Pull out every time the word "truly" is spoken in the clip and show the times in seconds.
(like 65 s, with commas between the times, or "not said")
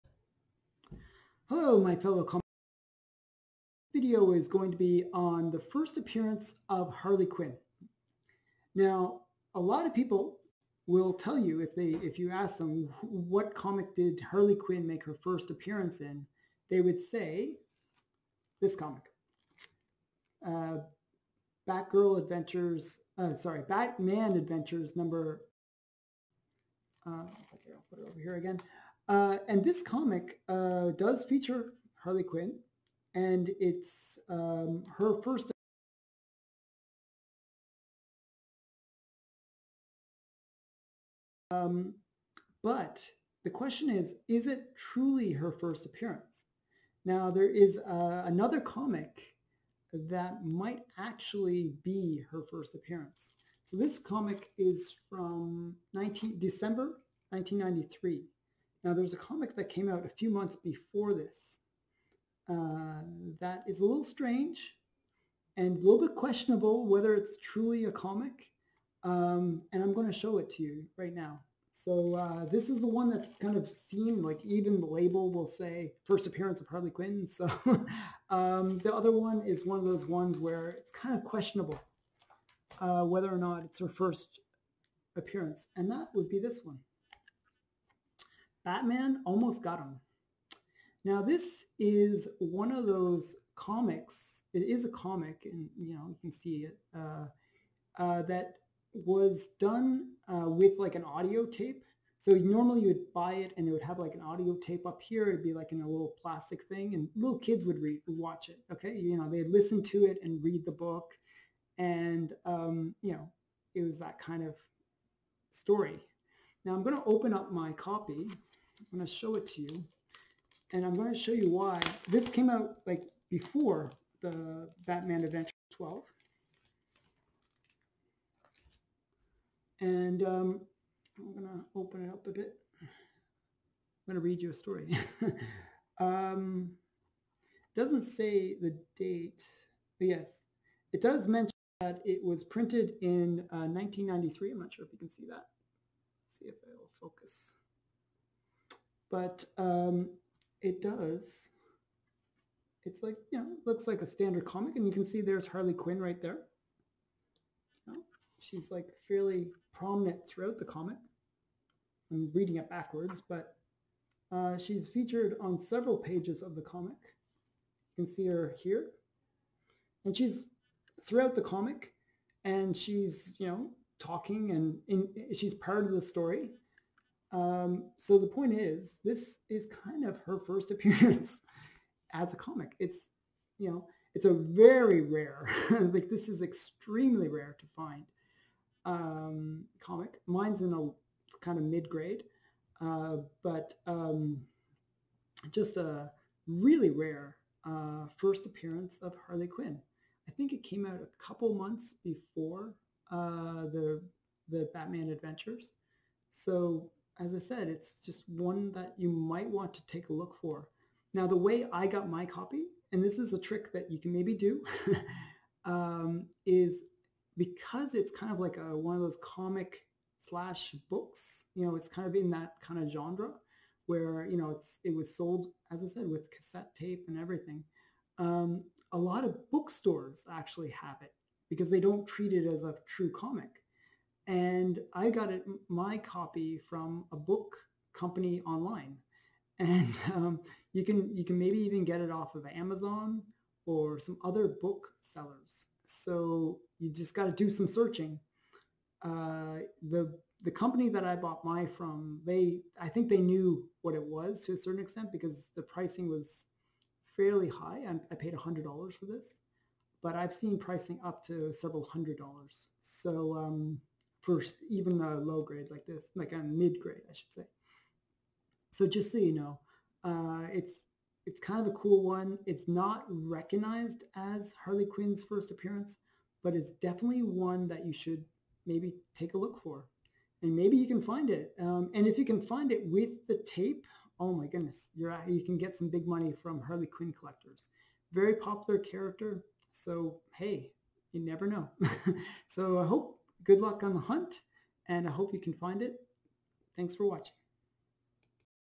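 44 s, 67 s.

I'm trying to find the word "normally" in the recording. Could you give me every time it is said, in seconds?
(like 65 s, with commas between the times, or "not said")
102 s.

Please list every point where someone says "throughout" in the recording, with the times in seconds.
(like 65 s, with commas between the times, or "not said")
160 s, 171 s.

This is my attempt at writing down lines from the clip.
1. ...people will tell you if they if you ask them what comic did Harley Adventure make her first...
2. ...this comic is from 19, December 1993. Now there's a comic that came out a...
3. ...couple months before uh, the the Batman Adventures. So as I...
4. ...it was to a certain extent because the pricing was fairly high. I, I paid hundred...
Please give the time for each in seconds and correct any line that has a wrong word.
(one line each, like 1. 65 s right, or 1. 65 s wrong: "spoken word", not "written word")
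1. 9 s wrong: "Quinn", not "Adventure"
2. 53 s right
3. 201 s right
4. 253 s right.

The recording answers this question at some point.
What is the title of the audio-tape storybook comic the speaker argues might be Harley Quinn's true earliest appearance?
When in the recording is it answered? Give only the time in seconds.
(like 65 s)
88 s.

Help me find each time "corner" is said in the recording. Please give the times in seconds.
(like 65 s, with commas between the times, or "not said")
not said.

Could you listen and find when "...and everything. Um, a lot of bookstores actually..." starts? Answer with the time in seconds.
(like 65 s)
227 s.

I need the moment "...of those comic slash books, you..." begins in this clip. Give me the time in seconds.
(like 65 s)
218 s.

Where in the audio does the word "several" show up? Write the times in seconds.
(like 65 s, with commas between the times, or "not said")
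165 s, 261 s.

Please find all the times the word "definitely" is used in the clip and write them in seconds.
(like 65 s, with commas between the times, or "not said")
276 s.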